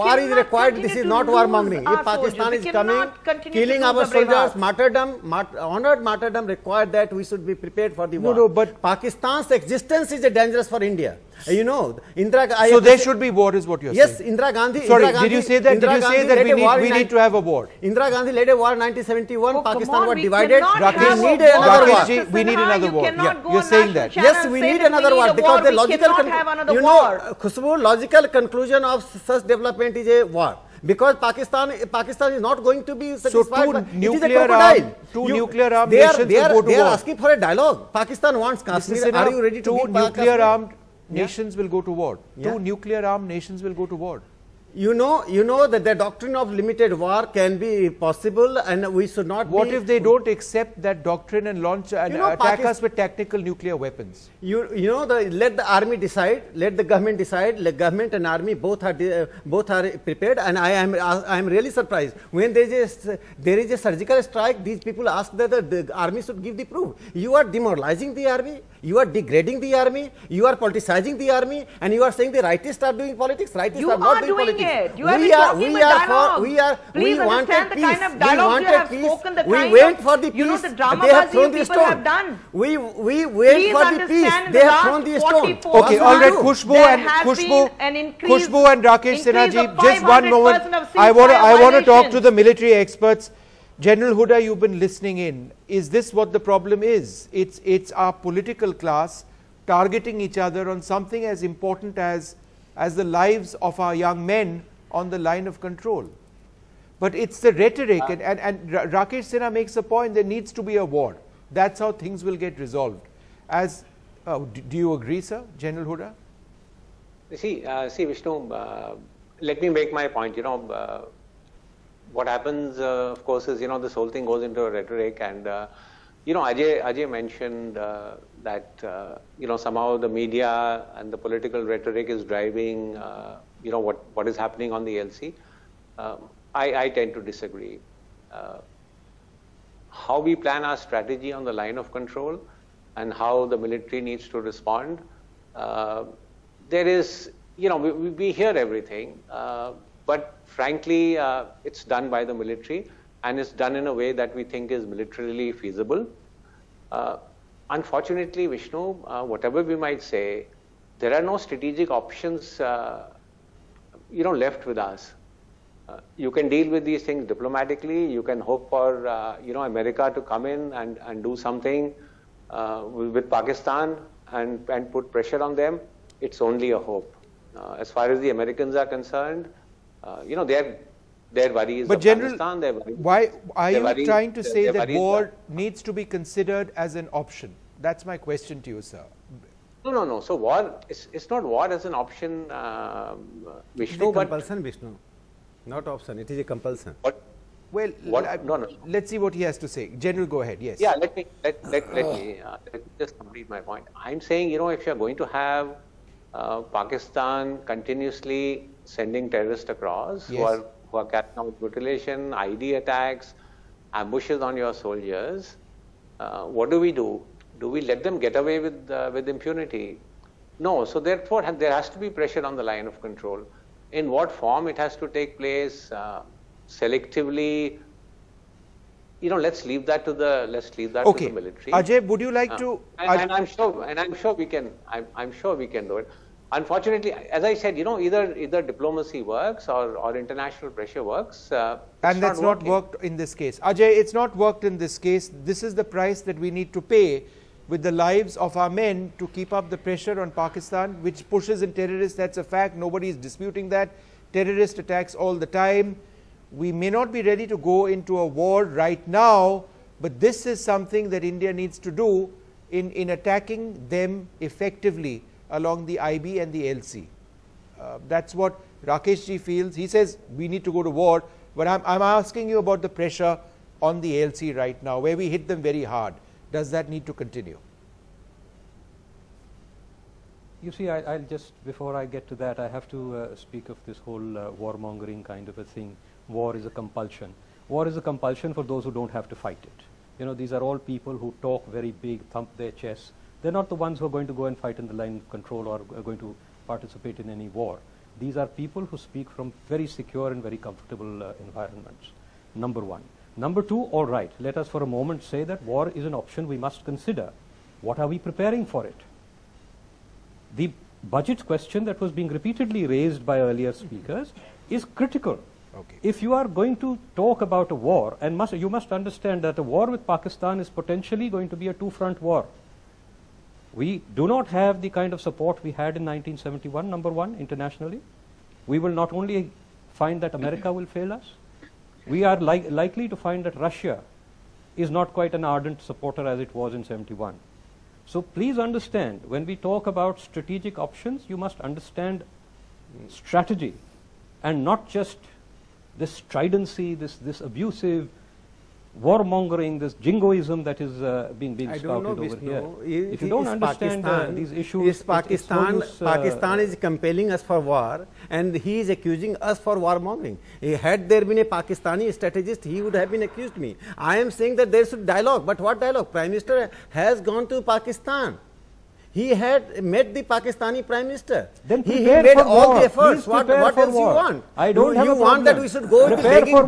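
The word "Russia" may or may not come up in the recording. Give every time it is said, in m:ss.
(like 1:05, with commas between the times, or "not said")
5:33.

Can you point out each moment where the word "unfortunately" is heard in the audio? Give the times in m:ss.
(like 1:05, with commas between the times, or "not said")
2:37, 3:56.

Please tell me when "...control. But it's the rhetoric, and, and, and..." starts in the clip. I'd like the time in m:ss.
1:45.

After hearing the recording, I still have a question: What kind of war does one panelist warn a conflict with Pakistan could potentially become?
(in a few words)
two-front war.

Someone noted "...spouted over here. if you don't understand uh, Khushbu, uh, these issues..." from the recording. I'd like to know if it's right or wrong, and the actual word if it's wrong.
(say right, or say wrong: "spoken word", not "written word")
wrong: "Pakistan", not "Khushbu".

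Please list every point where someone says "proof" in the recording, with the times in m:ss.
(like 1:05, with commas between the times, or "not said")
1:06.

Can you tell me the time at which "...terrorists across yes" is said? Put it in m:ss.
3:29.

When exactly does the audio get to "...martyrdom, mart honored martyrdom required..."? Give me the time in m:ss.
0:04.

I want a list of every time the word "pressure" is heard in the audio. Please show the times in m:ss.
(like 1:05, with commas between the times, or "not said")
2:55, 3:42, 4:00, 4:09, 4:32.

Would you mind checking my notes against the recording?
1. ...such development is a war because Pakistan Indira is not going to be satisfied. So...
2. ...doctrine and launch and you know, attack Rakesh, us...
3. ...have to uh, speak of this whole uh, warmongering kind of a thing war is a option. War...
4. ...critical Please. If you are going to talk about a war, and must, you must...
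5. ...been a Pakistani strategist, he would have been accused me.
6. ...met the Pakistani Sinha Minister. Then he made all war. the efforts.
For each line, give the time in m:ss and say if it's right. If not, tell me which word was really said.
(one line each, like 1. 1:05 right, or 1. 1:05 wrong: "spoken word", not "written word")
1. 0:29 wrong: "Pakistan", not "Indira"
2. 0:51 wrong: "Pakistan", not "Rakesh"
3. 4:42 wrong: "compulsion", not "option"
4. 5:14 wrong: "Okay", not "Please"
5. 6:01 right
6. 6:09 wrong: "Prime", not "Sinha".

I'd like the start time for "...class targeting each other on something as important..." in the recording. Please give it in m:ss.
1:38.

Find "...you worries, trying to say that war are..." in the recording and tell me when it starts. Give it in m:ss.
3:03.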